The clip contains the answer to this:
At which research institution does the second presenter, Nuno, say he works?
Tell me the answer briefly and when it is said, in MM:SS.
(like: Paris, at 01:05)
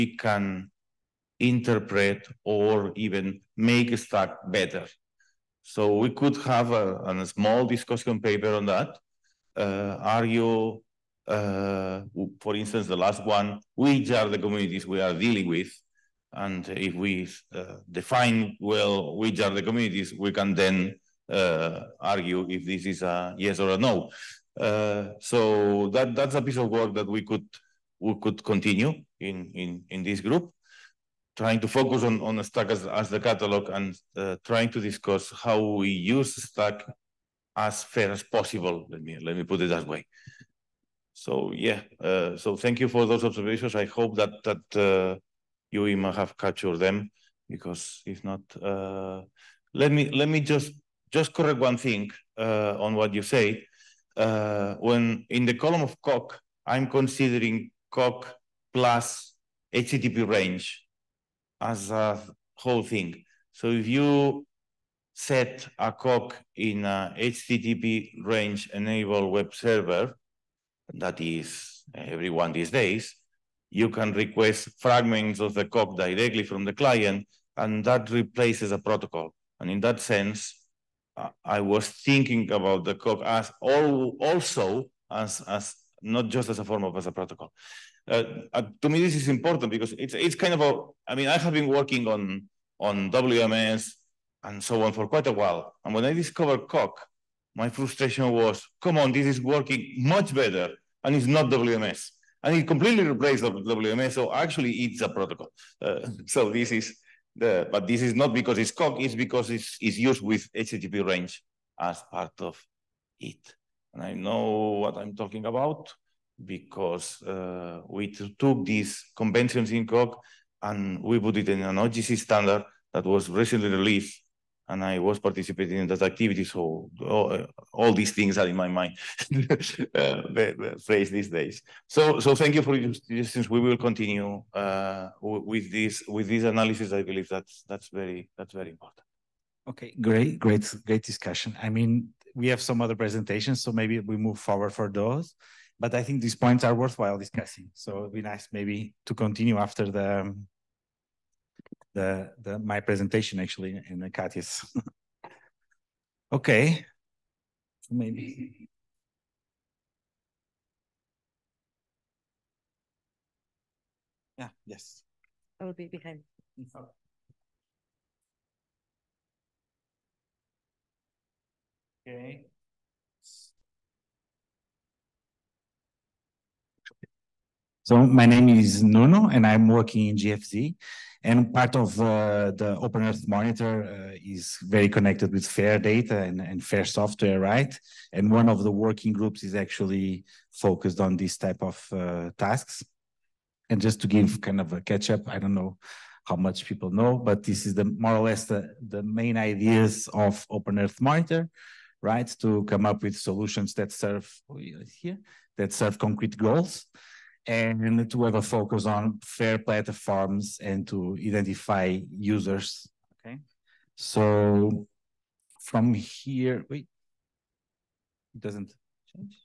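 GFZ, at 03:00.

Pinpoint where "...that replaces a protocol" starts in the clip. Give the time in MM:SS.
01:17.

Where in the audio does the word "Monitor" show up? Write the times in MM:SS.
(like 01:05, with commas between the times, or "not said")
03:03, 03:21.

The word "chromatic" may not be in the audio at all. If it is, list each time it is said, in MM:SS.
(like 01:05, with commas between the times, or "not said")
not said.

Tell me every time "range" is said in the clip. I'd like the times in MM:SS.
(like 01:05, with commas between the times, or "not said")
01:00, 01:08, 01:51.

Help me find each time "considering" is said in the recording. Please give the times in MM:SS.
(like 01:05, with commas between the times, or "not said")
00:56.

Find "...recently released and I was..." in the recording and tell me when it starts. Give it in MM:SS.
02:03.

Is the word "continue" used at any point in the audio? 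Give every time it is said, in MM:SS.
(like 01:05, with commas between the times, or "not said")
00:28, 02:13, 02:29.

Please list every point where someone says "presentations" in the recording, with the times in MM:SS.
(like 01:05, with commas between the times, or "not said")
02:22, 02:32.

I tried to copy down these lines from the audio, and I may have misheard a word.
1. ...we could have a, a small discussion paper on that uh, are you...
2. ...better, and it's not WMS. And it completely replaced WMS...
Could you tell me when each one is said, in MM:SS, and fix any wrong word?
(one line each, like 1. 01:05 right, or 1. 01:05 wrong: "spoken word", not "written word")
1. 00:05 right
2. 01:40 right.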